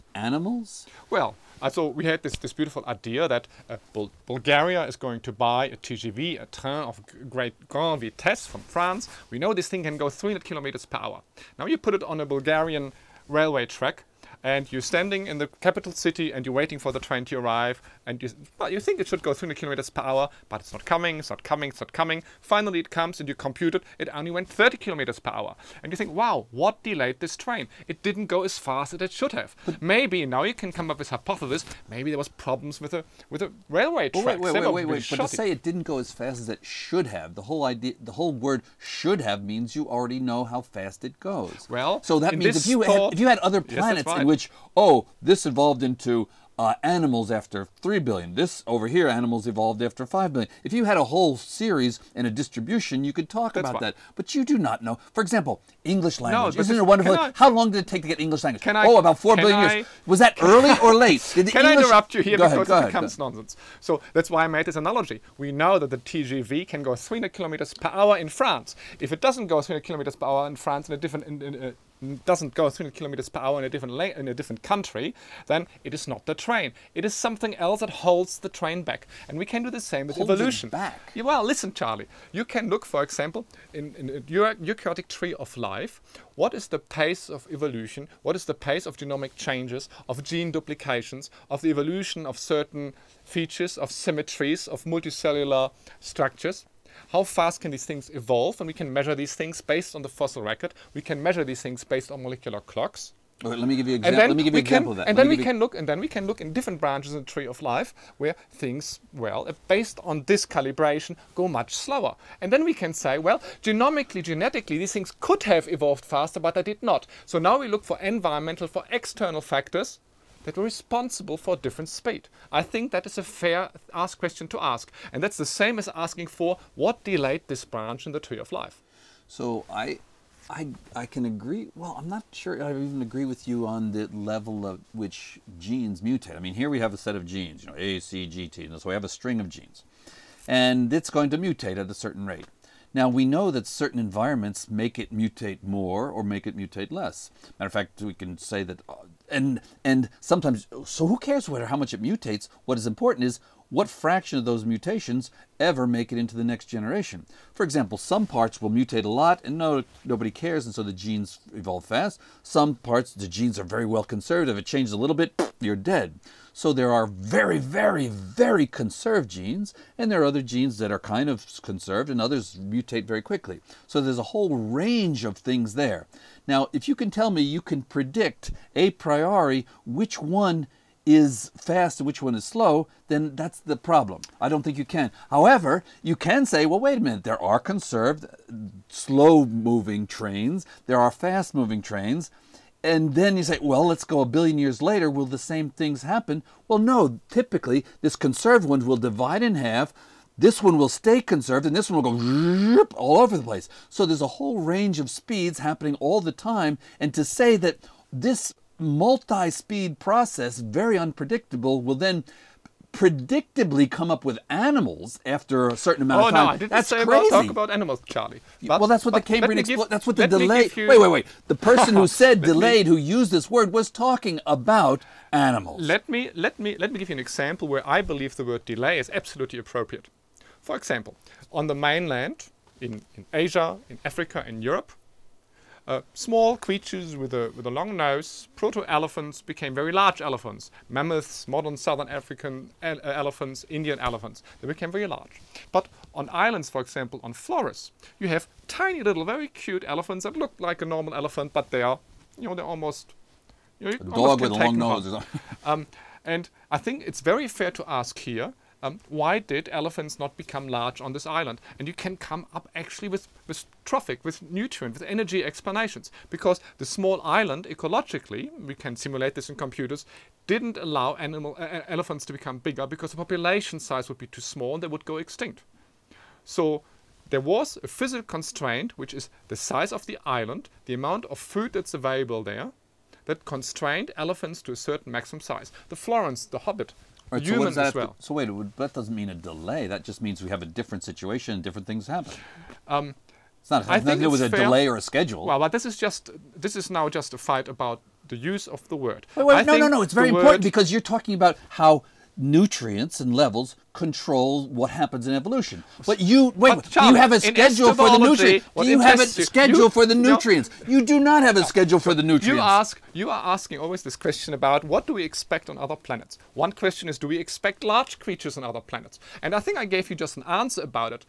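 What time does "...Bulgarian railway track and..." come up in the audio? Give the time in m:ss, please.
0:12.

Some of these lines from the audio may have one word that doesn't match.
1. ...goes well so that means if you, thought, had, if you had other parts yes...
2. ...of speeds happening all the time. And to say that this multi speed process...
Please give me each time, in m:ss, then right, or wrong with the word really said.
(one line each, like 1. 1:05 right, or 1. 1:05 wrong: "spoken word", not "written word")
1. 0:41 wrong: "planets", not "parts"
2. 3:25 right.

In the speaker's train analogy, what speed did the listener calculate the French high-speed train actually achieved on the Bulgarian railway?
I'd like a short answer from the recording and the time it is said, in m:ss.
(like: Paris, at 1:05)
30 km/h, at 0:24.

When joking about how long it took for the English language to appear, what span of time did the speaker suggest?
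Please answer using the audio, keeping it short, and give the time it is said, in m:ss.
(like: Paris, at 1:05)
4 billion years, at 0:59.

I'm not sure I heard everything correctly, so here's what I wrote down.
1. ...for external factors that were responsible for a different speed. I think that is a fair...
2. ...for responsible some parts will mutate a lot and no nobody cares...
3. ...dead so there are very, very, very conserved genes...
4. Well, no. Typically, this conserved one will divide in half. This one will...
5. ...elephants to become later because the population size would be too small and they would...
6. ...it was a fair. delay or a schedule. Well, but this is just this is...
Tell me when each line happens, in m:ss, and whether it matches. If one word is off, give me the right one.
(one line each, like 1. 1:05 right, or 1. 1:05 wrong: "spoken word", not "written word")
1. 1:58 right
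2. 2:37 wrong: "example", not "responsible"
3. 2:45 right
4. 3:16 right
5. 4:31 wrong: "bigger", not "later"
6. 4:54 right.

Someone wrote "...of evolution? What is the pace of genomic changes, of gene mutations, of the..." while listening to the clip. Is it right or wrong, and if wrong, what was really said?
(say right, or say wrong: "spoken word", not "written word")
wrong: "duplications", not "mutations".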